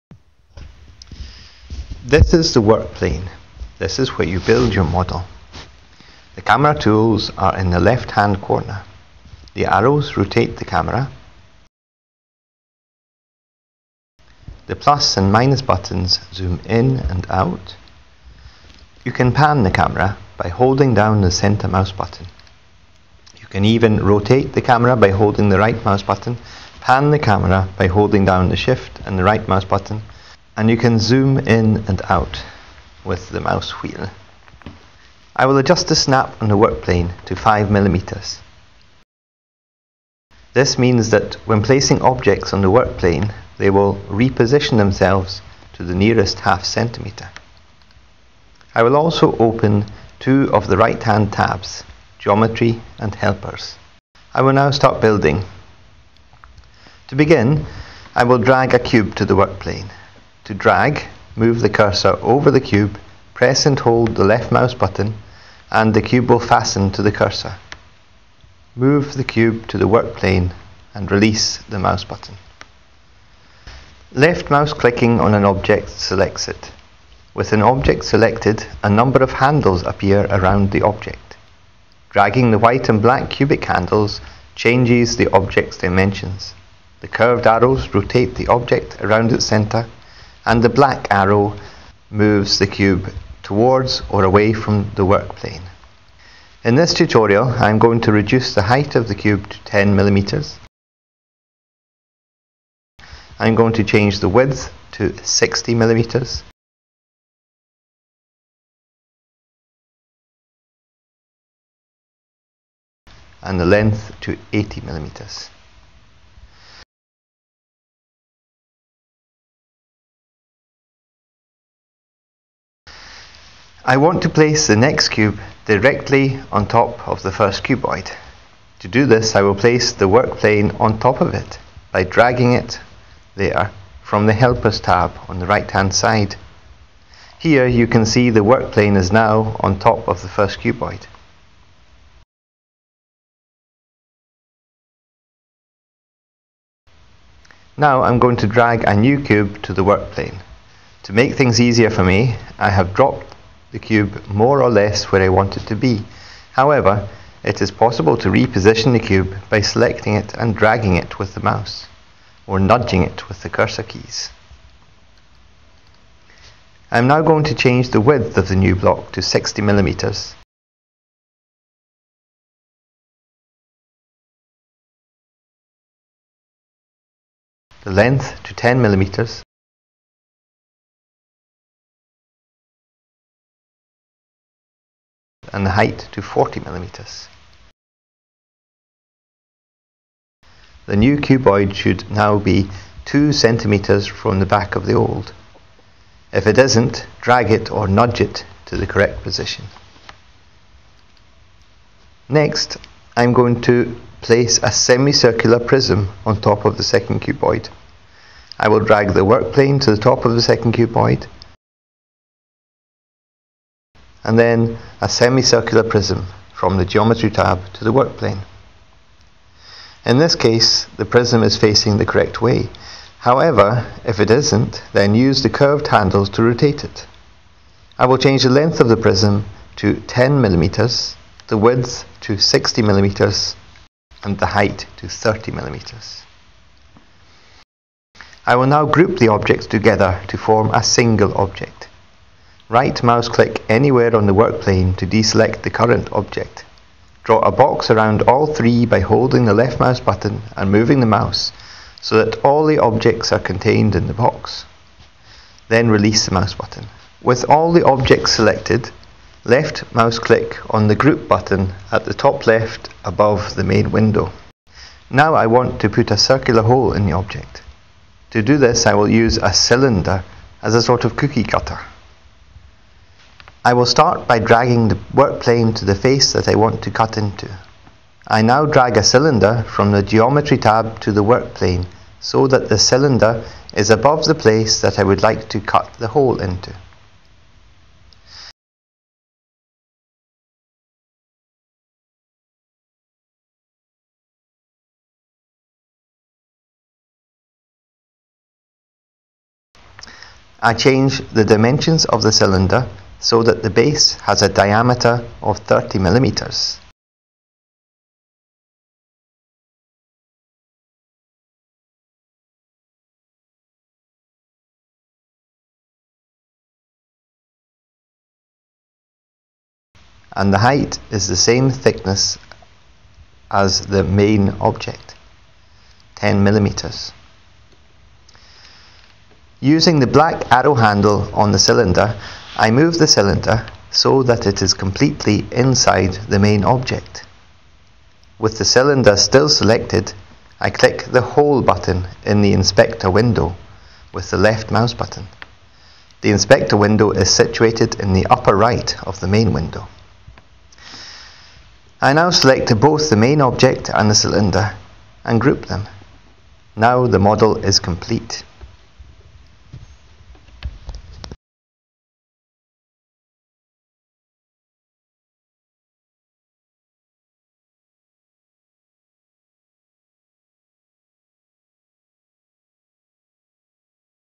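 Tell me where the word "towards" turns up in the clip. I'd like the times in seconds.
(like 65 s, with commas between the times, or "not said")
93 s.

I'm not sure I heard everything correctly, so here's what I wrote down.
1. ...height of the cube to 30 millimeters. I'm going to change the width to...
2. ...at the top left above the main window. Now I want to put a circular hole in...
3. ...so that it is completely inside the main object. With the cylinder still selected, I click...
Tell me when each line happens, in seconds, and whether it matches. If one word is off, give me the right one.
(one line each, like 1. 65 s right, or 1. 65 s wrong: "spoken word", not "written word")
1. 98 s wrong: "10", not "30"
2. 261 s right
3. 333 s right.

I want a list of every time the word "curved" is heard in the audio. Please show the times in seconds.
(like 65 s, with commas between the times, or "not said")
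87 s, 225 s.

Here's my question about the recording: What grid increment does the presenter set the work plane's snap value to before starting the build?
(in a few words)
5mm.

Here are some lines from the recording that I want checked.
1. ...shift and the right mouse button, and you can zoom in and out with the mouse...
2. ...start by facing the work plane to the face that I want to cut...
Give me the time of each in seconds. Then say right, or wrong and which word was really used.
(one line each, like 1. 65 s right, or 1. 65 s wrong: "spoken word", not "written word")
1. 28 s right
2. 273 s wrong: "dragging", not "facing".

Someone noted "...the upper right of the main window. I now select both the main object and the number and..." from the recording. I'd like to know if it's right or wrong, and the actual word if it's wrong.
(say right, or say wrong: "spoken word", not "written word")
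wrong: "cylinder", not "number".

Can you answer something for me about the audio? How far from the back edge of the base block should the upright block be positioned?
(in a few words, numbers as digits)
2 centimeters.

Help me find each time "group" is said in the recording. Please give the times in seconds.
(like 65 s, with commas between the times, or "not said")
238 s, 260 s, 355 s.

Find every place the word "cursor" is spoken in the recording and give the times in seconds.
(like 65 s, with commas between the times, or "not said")
61 s, 67 s, 163 s.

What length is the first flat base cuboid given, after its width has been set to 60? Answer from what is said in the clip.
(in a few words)
80 millimeters.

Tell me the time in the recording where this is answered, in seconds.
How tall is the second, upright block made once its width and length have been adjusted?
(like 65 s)
186 s.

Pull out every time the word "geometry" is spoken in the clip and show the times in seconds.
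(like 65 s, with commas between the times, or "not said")
52 s, 216 s, 280 s.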